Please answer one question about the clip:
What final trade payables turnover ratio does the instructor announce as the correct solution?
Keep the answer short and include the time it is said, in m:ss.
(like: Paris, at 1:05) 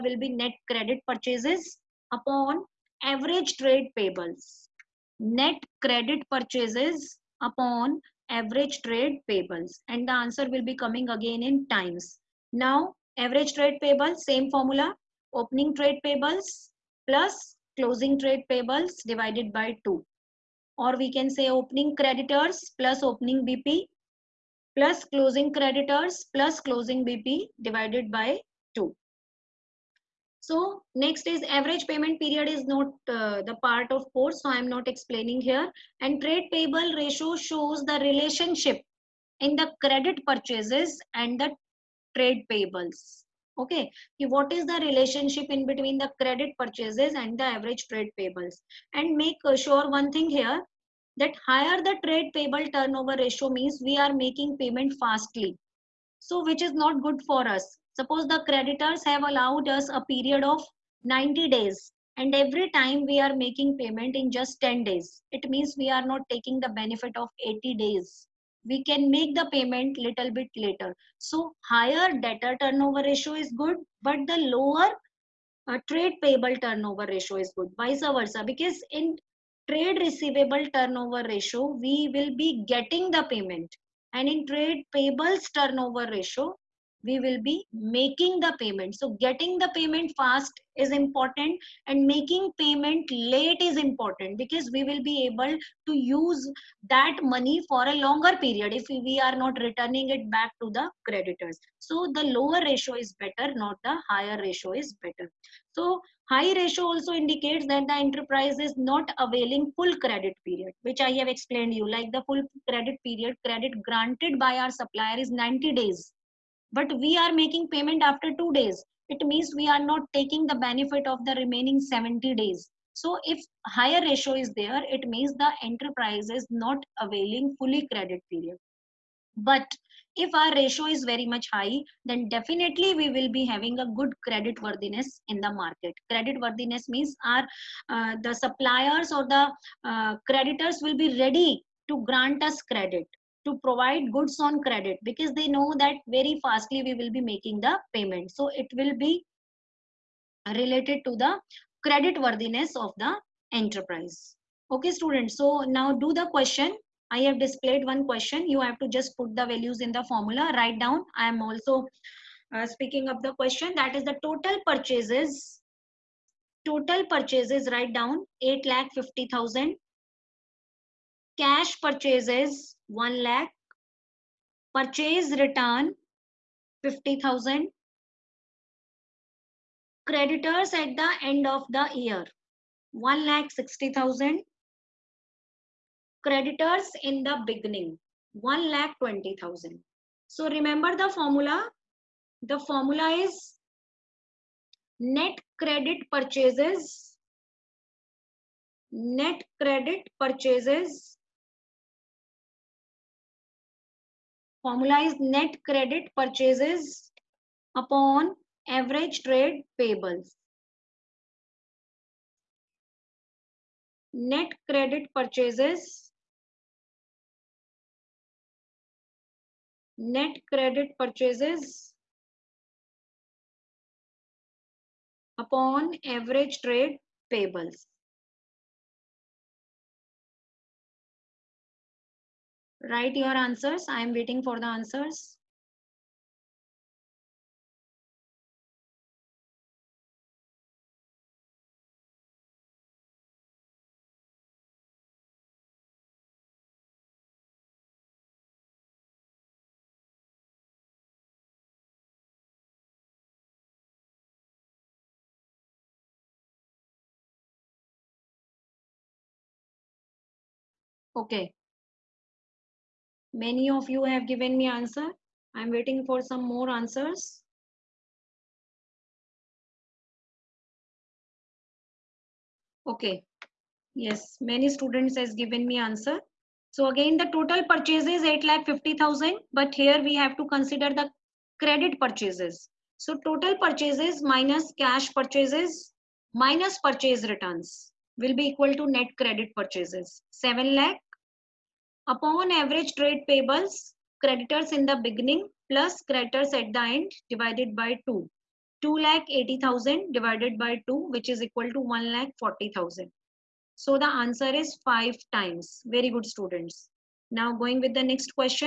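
5 times, at 5:04.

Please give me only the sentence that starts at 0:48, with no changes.
And make sure one thing here that higher the trade payable turnover ratio means we are making payment fastly.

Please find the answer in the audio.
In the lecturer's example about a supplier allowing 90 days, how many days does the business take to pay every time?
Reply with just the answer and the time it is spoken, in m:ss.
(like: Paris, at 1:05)
10 days, at 1:04.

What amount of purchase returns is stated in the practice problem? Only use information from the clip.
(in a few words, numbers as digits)
50,000.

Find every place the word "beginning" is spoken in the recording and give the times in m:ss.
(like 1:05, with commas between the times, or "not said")
3:07, 4:55.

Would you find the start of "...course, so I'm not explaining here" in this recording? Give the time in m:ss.
0:34.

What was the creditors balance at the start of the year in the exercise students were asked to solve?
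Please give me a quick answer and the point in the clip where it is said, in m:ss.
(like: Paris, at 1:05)
1 lakh 20,000, at 3:08.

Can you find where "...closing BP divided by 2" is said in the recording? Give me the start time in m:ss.
0:26.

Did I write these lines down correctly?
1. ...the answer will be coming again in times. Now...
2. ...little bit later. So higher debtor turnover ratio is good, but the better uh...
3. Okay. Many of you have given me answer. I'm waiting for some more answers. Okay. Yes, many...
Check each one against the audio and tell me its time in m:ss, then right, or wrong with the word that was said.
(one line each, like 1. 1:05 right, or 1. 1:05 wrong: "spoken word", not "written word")
1. 0:10 right
2. 1:09 wrong: "lower", not "better"
3. 4:21 right.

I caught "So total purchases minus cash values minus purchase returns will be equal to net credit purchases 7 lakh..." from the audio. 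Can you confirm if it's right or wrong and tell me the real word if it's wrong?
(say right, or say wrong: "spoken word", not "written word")
wrong: "purchases", not "values".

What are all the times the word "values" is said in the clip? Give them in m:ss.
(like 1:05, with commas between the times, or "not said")
2:39.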